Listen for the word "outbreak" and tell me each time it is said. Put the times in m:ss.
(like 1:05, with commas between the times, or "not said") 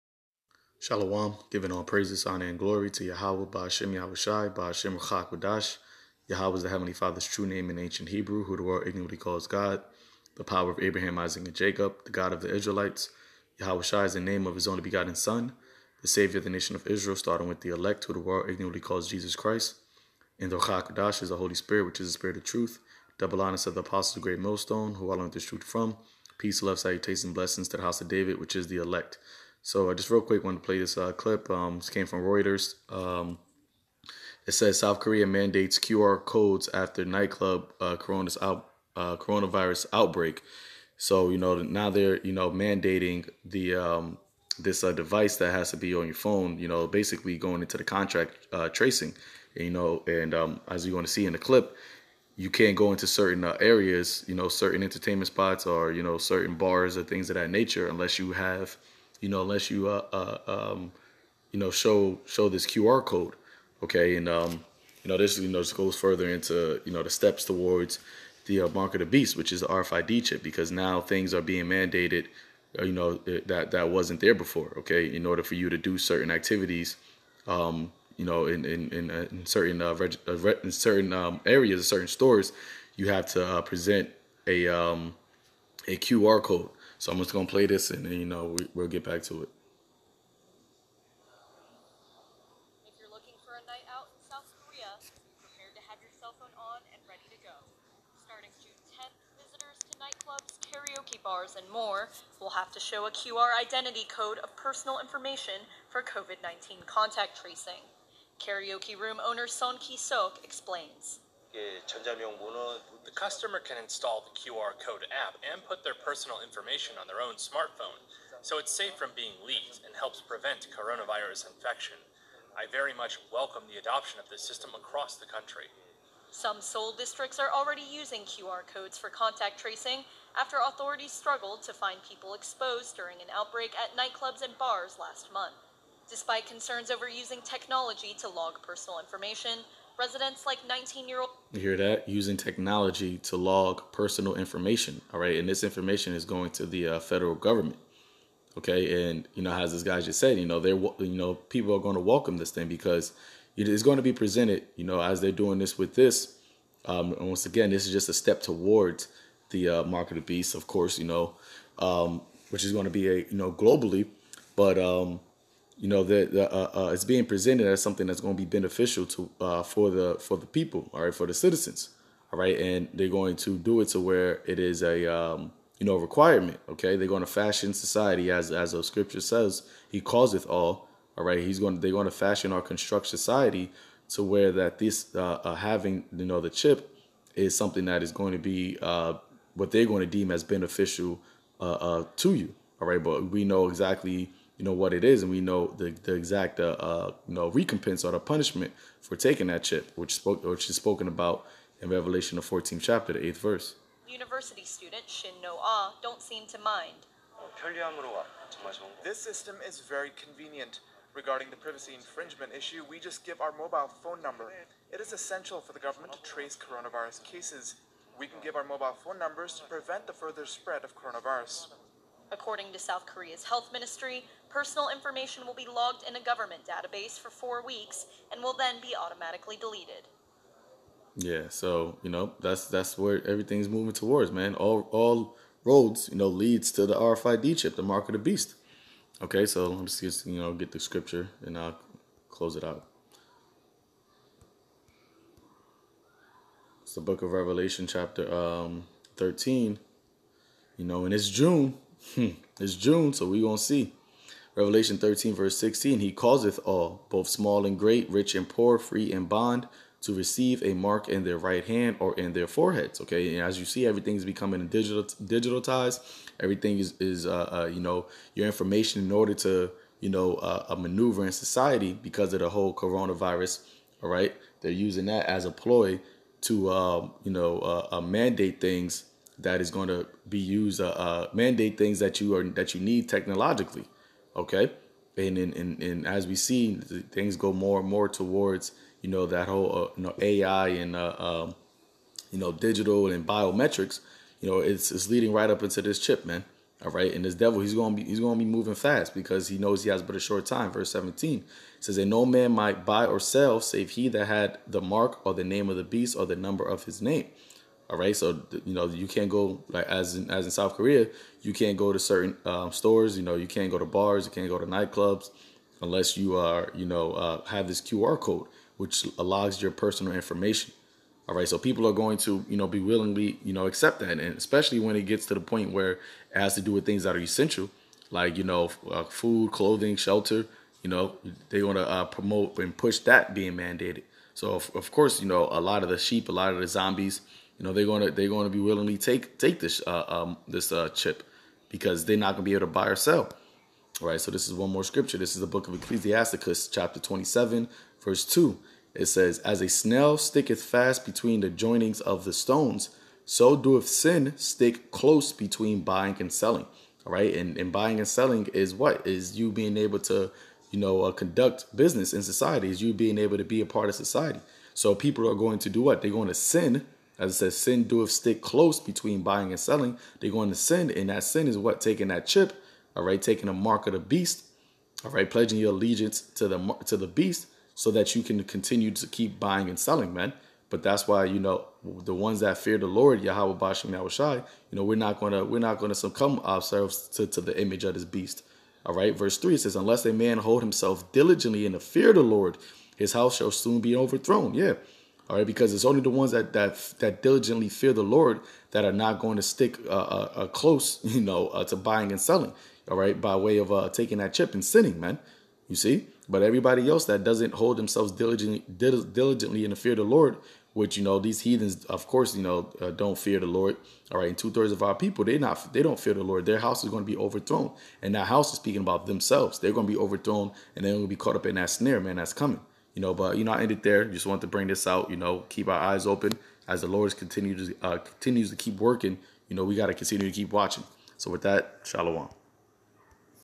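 0:39, 2:13.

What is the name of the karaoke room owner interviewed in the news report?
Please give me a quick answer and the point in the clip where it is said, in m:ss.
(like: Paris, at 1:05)
Son Ki-sok, at 1:49.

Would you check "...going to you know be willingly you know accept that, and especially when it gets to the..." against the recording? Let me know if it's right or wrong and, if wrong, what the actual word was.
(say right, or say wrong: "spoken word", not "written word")
right.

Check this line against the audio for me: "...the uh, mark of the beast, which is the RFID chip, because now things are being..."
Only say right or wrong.
right.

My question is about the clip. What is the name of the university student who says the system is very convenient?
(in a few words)
Shin No Ah.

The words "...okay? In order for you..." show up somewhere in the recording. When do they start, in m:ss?
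1:14.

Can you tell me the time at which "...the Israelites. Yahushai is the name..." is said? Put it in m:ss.
0:12.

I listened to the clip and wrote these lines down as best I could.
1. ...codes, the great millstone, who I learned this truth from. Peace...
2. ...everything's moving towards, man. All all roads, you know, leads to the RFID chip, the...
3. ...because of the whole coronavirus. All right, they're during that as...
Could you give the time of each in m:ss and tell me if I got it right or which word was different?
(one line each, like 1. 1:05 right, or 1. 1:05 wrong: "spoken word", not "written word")
1. 0:23 wrong: "apostles", not "codes"
2. 3:53 right
3. 4:32 wrong: "using", not "during".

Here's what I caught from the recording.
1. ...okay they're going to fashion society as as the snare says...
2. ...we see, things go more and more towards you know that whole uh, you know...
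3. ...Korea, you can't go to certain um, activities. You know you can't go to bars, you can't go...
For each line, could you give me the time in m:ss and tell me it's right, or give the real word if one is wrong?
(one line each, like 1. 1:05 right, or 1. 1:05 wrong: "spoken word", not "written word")
1. 2:56 wrong: "scripture", not "snare"
2. 4:46 right
3. 5:10 wrong: "stores", not "activities".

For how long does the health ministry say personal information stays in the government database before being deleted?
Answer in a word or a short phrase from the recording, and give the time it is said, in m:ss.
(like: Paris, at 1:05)
4 weeks, at 3:47.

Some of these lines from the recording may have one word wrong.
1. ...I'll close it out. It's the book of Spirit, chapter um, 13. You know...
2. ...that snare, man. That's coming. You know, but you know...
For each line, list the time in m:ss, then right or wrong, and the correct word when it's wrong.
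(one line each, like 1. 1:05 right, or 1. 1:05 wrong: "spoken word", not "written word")
1. 4:01 wrong: "Revelation", not "Spirit"
2. 7:01 right.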